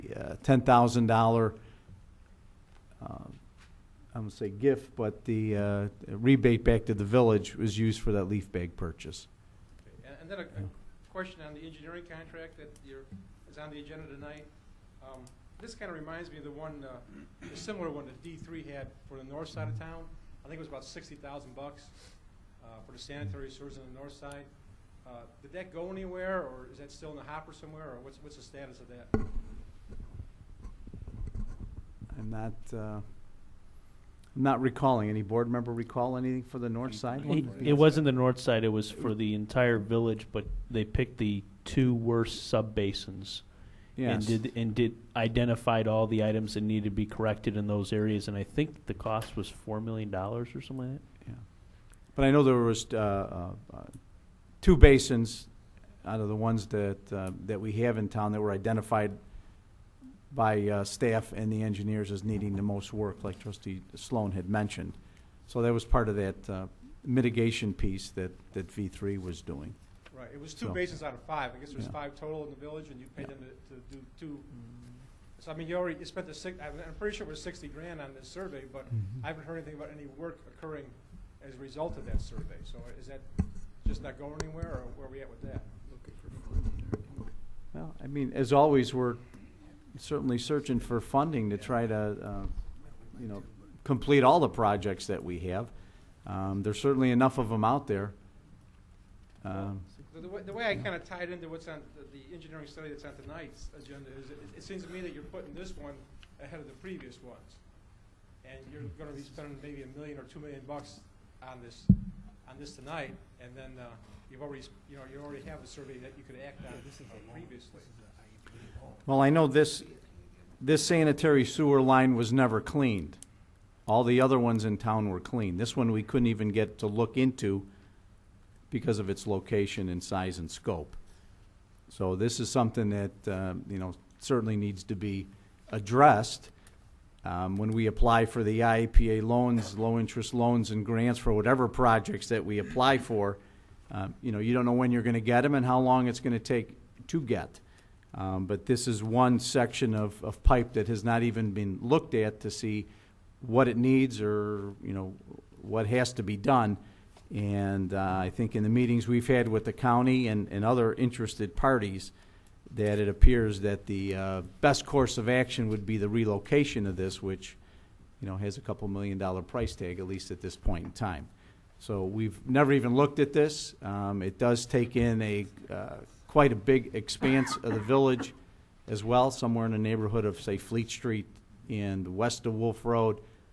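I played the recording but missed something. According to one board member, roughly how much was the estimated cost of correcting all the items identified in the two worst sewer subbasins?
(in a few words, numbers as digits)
$4 million.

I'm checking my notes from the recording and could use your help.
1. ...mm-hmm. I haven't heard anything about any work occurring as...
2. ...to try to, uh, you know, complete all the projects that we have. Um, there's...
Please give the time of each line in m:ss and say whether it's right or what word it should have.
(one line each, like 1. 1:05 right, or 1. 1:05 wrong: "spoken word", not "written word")
1. 1:18 right
2. 1:31 right.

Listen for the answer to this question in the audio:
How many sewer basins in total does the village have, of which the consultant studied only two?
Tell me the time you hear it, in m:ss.
1:11.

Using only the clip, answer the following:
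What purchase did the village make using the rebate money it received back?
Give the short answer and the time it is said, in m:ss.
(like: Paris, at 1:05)
leaf bag purchase, at 0:08.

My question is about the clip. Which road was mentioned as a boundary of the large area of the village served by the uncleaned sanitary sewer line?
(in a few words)
Wolf Road.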